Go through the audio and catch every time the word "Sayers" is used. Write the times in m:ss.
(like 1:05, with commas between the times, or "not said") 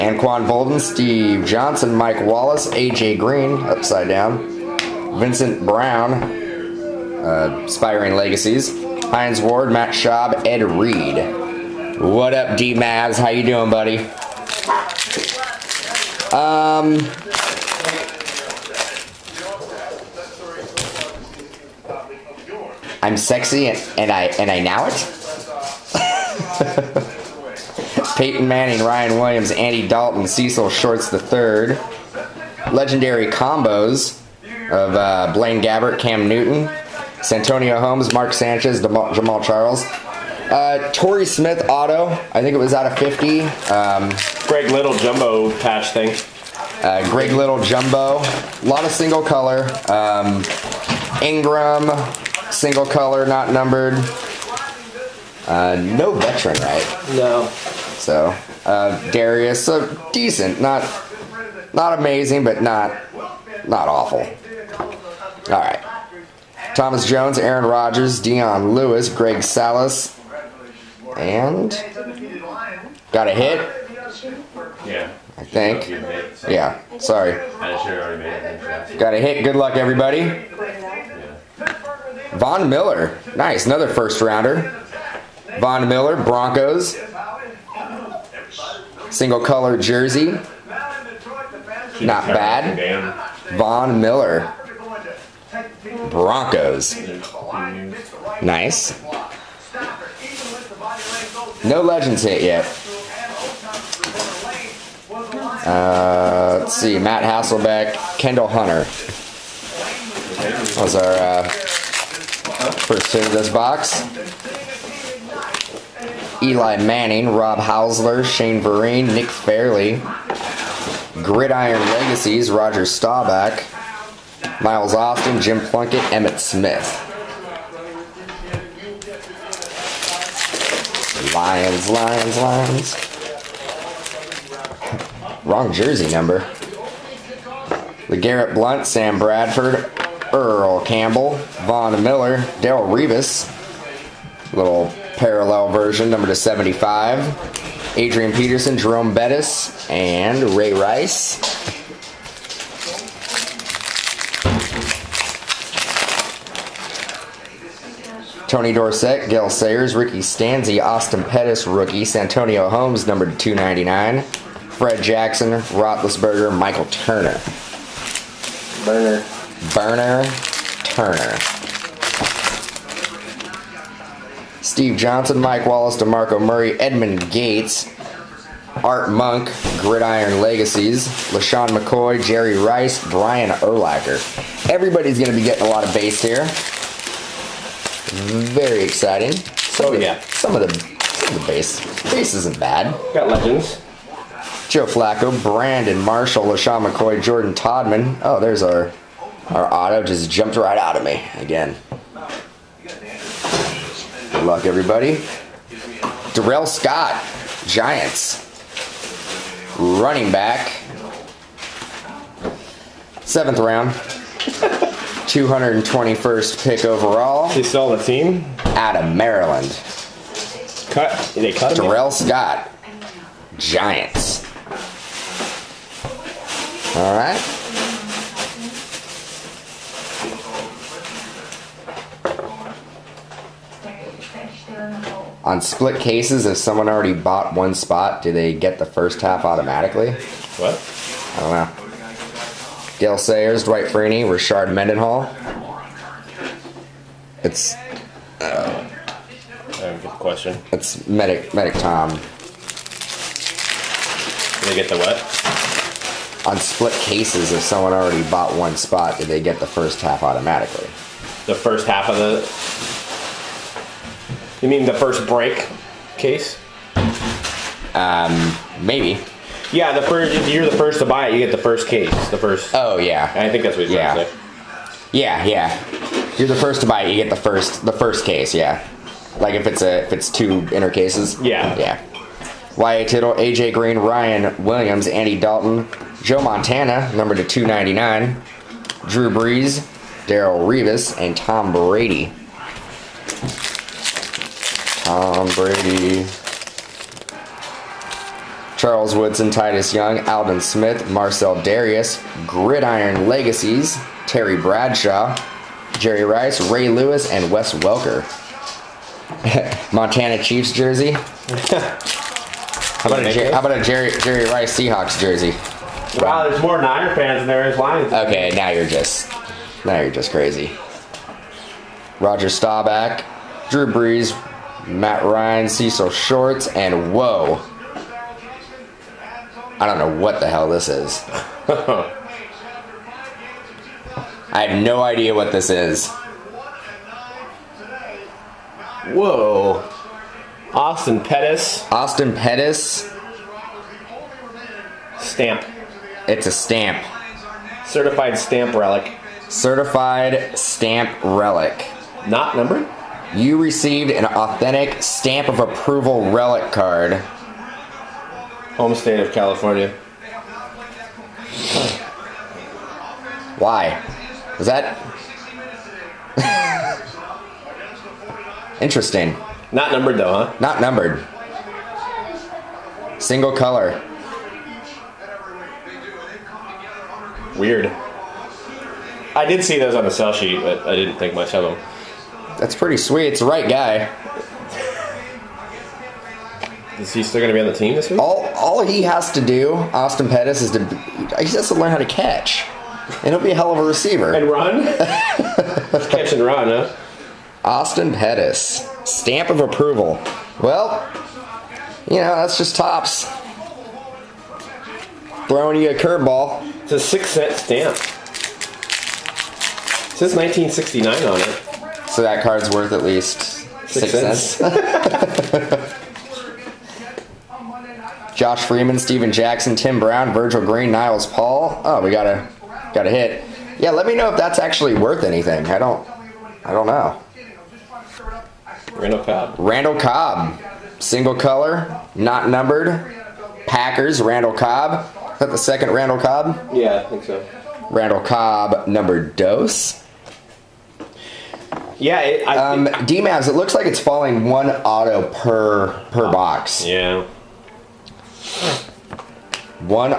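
2:39, 4:03.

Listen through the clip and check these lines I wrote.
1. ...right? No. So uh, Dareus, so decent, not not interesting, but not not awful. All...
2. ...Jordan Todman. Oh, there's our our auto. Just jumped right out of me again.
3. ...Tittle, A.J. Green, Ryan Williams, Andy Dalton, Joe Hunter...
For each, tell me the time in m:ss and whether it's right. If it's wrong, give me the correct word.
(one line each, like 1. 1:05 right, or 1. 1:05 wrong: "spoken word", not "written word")
1. 0:56 wrong: "amazing", not "interesting"
2. 3:17 right
3. 4:43 wrong: "Montana", not "Hunter".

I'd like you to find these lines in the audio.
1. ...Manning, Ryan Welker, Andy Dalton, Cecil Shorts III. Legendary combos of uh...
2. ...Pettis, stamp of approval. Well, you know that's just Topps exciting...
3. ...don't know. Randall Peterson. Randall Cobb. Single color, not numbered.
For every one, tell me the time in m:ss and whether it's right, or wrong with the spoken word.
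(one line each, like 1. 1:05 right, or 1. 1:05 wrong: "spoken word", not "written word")
1. 0:28 wrong: "Williams", not "Welker"
2. 6:38 wrong: "throwing", not "exciting"
3. 7:06 wrong: "Cobb", not "Peterson".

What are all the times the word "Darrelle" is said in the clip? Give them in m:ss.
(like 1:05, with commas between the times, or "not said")
2:22, 4:50.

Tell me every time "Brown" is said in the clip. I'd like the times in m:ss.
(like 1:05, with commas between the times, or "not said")
0:05, 6:59.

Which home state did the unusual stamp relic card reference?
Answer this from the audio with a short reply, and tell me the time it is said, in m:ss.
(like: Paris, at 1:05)
California, at 5:58.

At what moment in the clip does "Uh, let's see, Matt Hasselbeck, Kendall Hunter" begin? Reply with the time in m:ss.
1:45.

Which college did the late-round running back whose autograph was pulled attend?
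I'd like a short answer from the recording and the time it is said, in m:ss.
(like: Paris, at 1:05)
Maryland, at 3:38.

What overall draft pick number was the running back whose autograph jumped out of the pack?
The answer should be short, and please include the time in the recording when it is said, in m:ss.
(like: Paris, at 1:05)
221st, at 3:35.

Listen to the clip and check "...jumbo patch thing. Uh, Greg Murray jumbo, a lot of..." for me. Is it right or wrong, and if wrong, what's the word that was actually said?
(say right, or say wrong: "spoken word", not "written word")
wrong: "Little", not "Murray".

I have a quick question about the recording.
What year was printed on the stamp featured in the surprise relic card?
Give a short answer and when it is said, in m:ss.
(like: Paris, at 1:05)
1969, at 6:50.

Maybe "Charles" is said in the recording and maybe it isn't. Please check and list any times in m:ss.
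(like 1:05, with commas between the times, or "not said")
0:39, 4:58.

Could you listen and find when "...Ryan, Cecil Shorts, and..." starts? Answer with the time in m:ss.
5:25.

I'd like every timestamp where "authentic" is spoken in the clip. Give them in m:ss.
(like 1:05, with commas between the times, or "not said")
5:54.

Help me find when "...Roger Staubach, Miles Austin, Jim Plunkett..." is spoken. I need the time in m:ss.
2:02.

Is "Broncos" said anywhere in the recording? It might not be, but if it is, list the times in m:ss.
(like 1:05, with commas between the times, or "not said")
1:26, 1:36.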